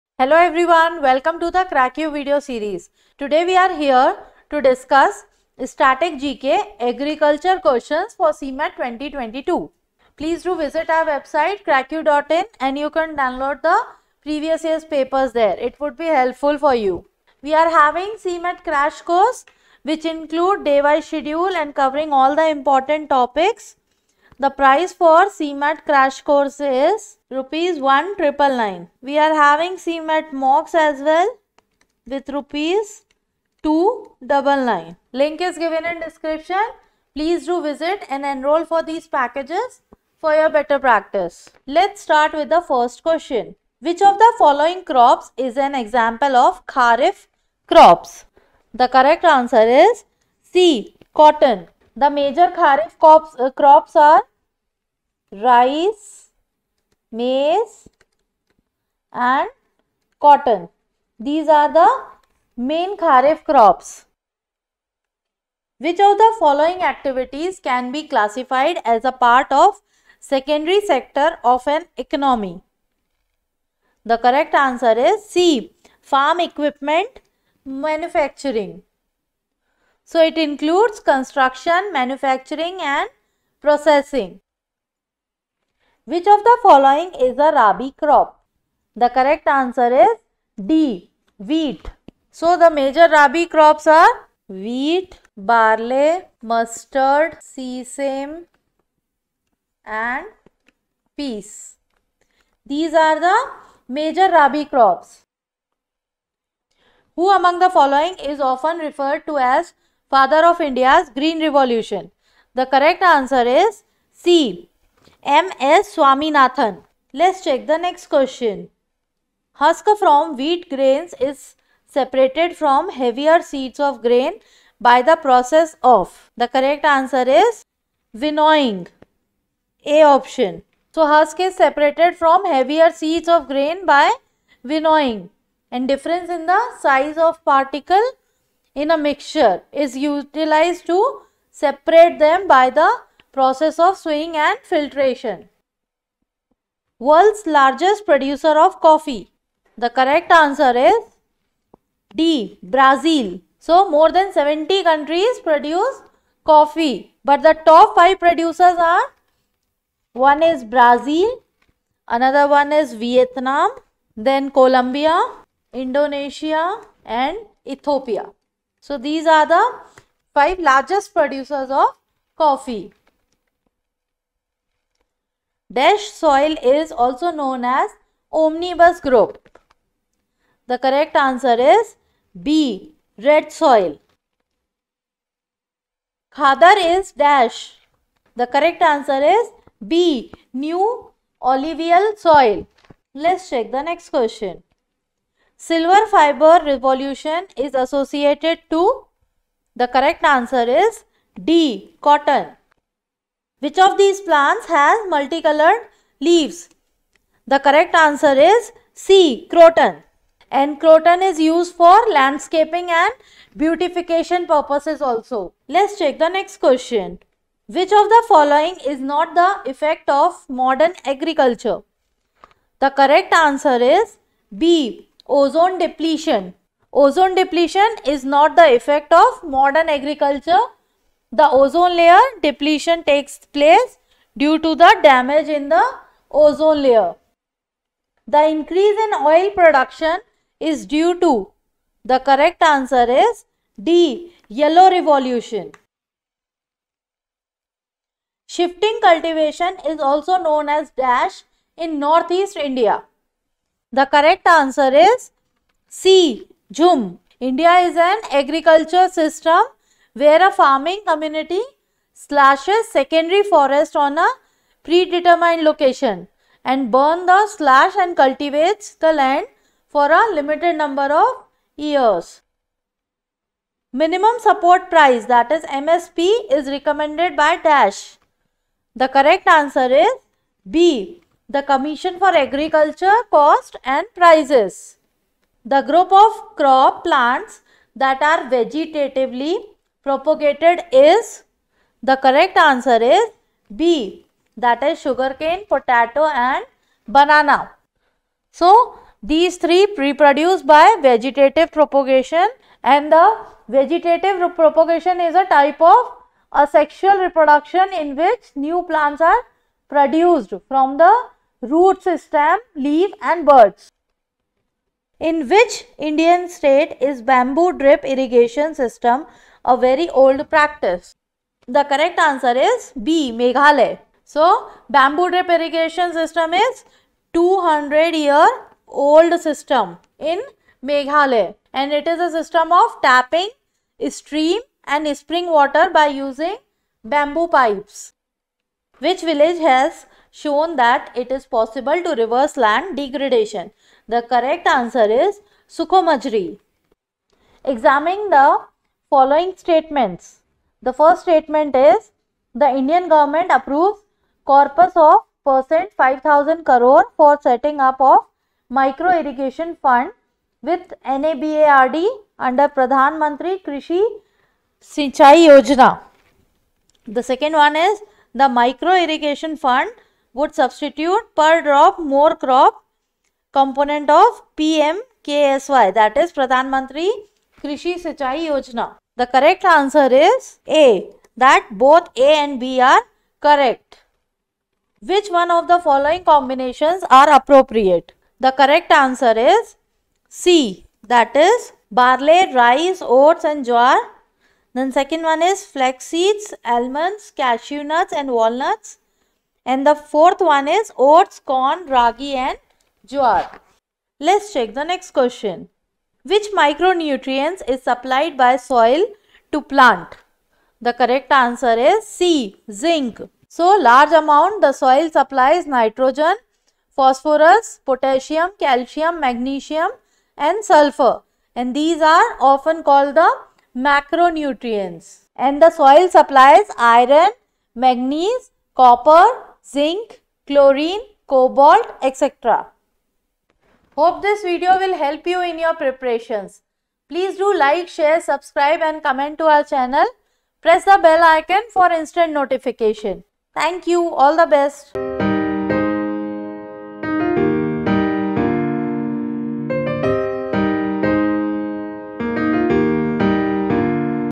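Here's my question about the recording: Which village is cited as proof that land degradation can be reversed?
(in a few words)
Sukhomajri.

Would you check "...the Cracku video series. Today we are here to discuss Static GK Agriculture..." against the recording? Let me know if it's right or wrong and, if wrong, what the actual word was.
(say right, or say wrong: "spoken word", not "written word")
right.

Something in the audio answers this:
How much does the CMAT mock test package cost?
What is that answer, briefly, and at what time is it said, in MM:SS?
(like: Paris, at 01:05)
Rs 299, at 00:32.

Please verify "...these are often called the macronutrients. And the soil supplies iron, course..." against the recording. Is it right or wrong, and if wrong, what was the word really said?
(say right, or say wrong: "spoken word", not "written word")
wrong: "manganese", not "course".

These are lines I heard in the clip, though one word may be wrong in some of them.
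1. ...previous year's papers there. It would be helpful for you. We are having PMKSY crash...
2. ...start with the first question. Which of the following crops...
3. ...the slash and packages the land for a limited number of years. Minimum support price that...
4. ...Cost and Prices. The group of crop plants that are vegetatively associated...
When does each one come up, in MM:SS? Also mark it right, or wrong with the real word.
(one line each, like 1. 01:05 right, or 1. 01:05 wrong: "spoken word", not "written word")
1. 00:14 wrong: "CMAT", not "PMKSY"
2. 00:42 right
3. 04:27 wrong: "cultivates", not "packages"
4. 04:43 wrong: "propagated", not "associated".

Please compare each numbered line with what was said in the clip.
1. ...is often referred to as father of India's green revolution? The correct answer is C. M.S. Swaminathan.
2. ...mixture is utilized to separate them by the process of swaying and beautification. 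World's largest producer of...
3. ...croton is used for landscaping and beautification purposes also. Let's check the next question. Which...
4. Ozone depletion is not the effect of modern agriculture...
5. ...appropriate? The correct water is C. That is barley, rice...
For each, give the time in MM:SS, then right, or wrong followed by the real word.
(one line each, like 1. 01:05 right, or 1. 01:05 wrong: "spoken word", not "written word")
1. 01:48 right
2. 02:18 wrong: "filtration", not "beautification"
3. 03:30 right
4. 03:46 right
5. 06:27 wrong: "answer", not "water".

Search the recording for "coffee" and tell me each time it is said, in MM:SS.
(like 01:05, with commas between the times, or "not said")
02:28, 02:36, 02:52.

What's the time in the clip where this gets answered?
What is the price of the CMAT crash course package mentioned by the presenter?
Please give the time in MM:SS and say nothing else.
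00:27.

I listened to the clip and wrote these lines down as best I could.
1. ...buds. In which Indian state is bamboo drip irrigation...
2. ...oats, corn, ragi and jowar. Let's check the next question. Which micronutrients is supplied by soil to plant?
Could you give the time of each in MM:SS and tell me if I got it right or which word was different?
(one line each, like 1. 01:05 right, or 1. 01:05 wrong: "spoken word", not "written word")
1. 05:13 right
2. 06:40 right.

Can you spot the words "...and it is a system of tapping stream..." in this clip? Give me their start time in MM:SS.
05:31.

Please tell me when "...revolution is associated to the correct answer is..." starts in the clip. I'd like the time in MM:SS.
03:16.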